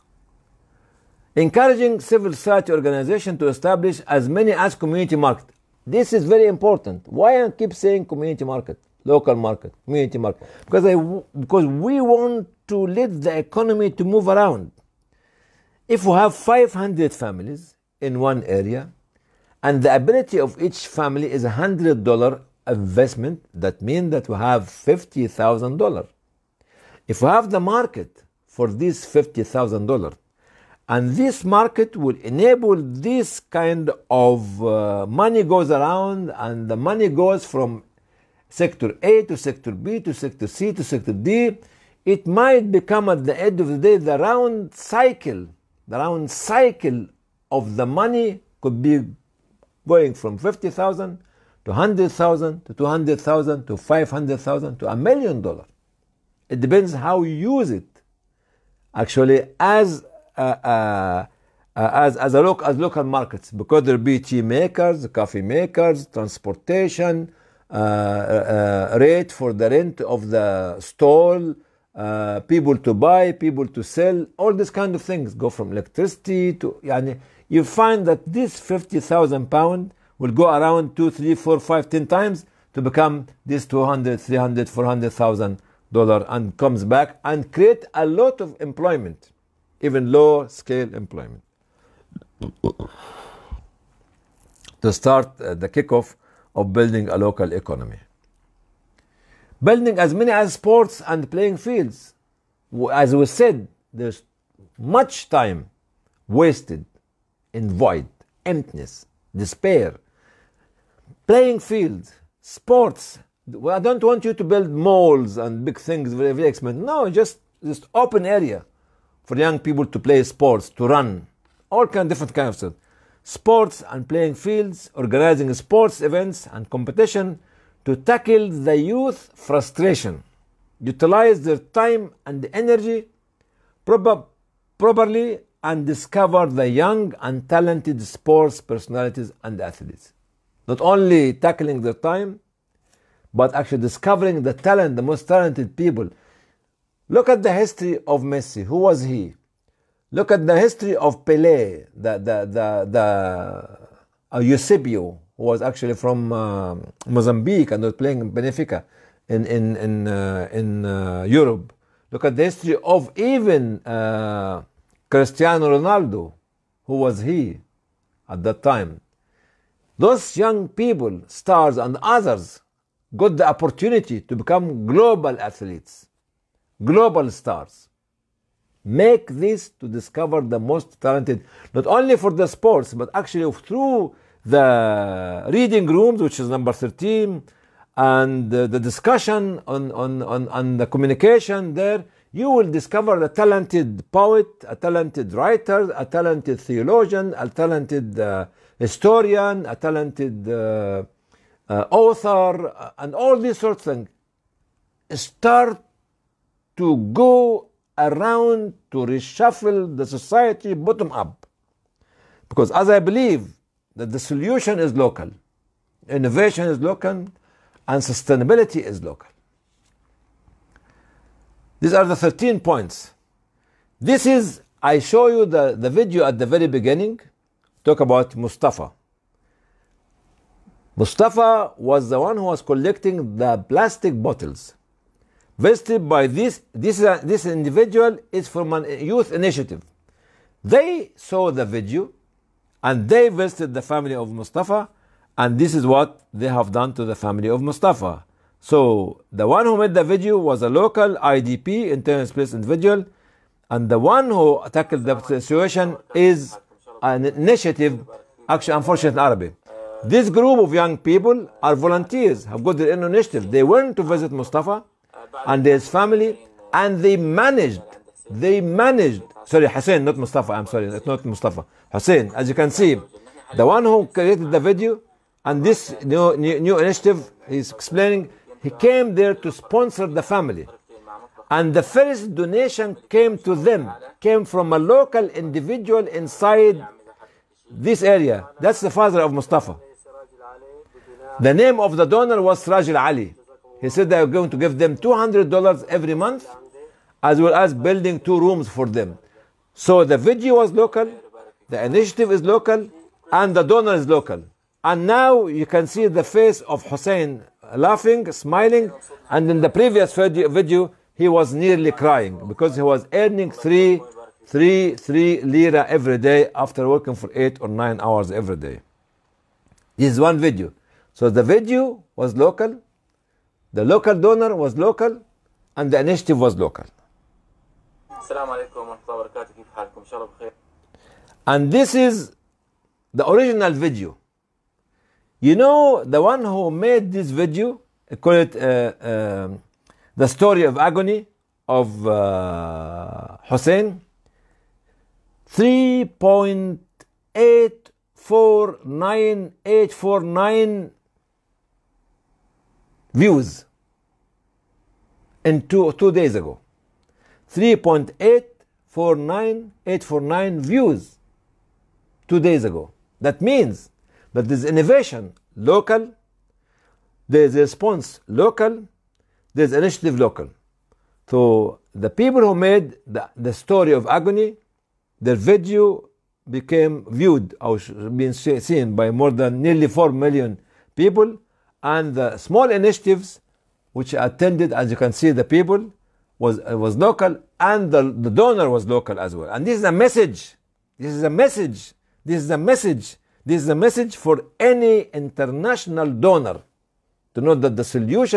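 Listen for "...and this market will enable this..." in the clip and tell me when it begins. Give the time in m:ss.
0:30.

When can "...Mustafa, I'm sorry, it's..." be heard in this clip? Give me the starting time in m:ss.
4:30.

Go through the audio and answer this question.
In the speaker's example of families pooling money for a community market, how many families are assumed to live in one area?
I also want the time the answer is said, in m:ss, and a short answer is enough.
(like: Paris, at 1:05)
500, at 0:16.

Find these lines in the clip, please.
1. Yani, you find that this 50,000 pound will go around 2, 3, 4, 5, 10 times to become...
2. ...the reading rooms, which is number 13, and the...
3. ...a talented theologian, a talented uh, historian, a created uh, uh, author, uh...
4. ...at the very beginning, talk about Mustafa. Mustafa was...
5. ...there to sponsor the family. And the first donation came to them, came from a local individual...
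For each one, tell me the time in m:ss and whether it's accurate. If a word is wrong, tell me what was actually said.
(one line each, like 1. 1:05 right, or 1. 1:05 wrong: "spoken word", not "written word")
1. 1:16 right
2. 3:04 right
3. 3:15 wrong: "talented", not "created"
4. 3:46 right
5. 4:39 right.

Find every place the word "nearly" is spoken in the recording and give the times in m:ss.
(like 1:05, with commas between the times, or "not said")
5:11, 6:19.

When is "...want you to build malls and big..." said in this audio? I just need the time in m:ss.
1:54.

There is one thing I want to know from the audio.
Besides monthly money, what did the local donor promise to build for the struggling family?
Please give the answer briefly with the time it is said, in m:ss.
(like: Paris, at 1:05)
Two rooms, at 4:58.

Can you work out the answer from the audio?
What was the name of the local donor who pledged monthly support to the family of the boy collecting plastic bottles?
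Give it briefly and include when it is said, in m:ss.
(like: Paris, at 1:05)
Siraj Ali, at 4:52.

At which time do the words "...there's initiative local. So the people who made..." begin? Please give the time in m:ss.
6:09.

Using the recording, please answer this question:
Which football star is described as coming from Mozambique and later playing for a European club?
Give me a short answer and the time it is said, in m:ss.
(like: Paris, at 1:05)
Eusebio, at 2:34.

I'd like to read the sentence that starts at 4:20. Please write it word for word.
This group of young people are volunteers, have got their own initiative.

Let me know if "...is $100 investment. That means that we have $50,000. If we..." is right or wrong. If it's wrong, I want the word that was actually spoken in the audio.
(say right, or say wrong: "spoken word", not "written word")
right.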